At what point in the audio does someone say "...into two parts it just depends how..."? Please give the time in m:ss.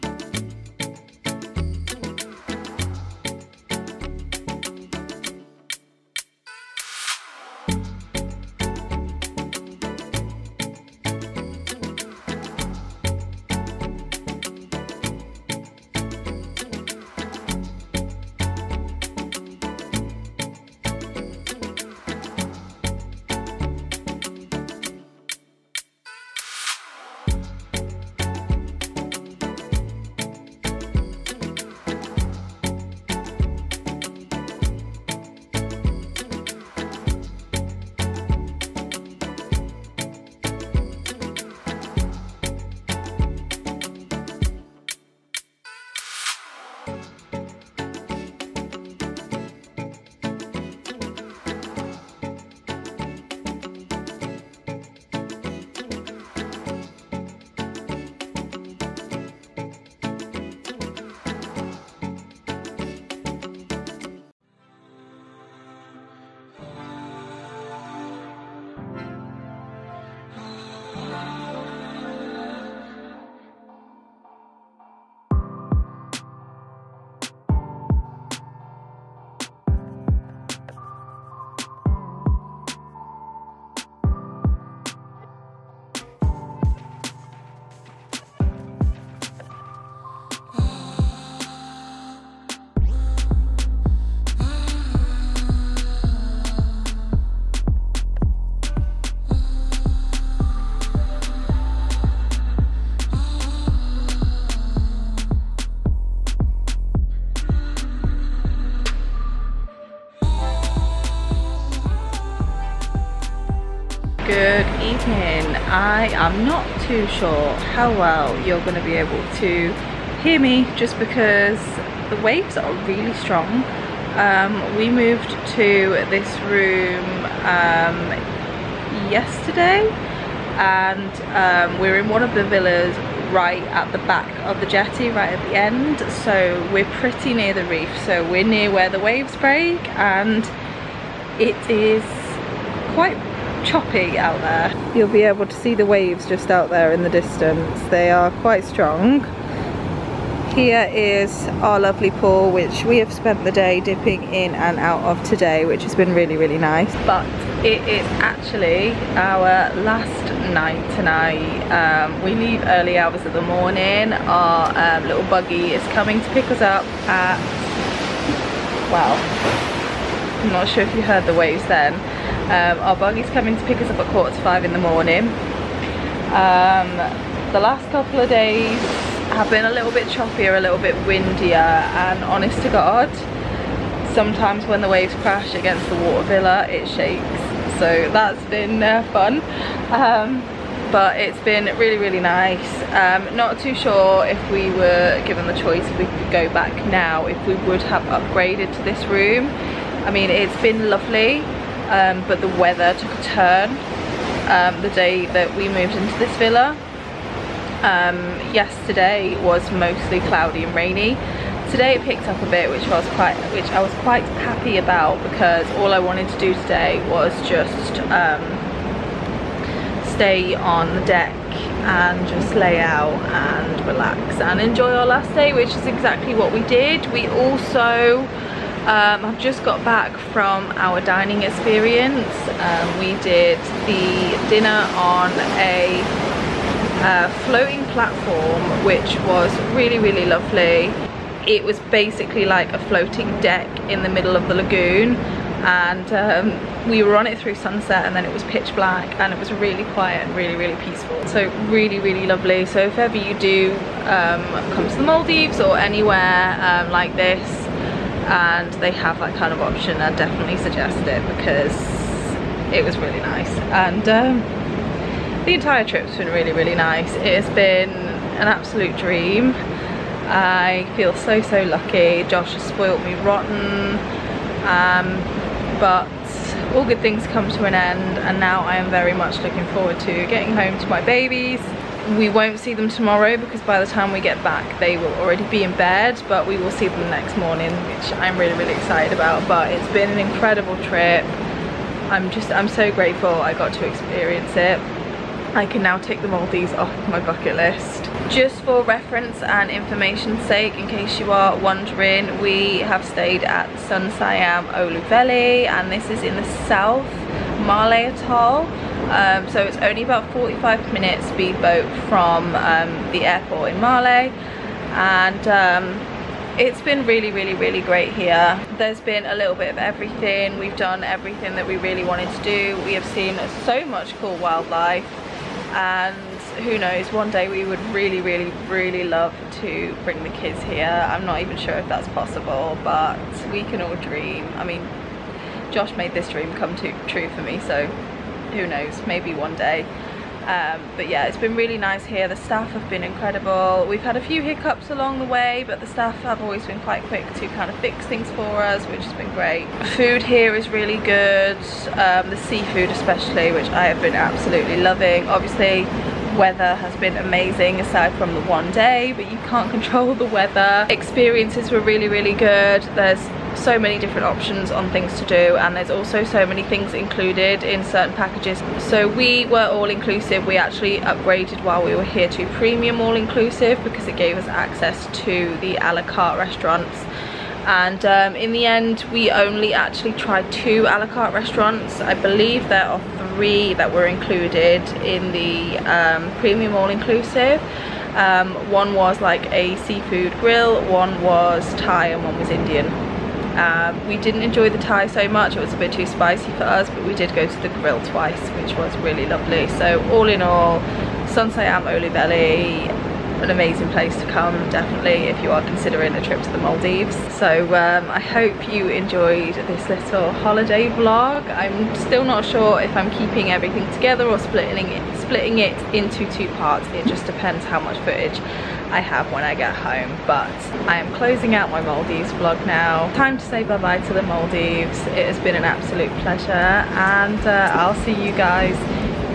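6:55.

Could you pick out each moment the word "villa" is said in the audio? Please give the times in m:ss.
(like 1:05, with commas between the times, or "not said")
2:12, 3:06, 3:26.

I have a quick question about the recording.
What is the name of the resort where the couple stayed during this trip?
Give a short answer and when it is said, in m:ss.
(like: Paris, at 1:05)
Sun Siyam Olhuveli, at 5:03.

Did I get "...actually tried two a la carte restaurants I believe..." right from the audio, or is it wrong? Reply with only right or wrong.
right.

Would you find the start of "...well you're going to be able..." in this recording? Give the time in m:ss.
1:57.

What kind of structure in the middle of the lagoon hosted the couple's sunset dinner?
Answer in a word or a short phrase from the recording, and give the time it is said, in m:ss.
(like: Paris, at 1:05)
Floating platform, at 3:57.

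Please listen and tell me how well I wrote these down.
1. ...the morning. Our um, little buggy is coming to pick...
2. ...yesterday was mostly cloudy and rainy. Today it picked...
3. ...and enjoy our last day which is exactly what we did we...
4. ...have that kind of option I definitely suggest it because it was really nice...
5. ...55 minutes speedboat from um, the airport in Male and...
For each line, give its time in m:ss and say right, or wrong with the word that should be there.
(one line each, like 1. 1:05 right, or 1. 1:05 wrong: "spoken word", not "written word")
1. 2:43 right
2. 3:28 right
3. 3:44 right
4. 4:18 right
5. 5:10 wrong: "45", not "55".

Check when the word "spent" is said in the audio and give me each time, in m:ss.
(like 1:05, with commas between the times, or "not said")
2:33.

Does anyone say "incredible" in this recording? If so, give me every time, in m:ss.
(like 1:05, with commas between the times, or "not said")
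4:50, 5:43.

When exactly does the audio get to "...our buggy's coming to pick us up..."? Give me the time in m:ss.
2:52.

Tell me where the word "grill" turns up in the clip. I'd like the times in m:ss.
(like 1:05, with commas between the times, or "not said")
6:30, 6:37.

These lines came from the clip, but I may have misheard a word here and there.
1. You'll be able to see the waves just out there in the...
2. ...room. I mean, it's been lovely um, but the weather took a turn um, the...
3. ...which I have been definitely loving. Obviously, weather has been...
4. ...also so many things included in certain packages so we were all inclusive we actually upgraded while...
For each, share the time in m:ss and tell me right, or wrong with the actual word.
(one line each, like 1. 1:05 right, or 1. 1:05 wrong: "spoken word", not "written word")
1. 2:24 right
2. 3:19 right
3. 5:53 wrong: "absolutely", not "definitely"
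4. 6:05 right.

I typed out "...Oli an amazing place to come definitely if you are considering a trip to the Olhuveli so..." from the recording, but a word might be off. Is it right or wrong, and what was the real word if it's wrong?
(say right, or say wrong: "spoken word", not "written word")
wrong: "Maldives", not "Olhuveli".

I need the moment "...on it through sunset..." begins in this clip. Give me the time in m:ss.
4:07.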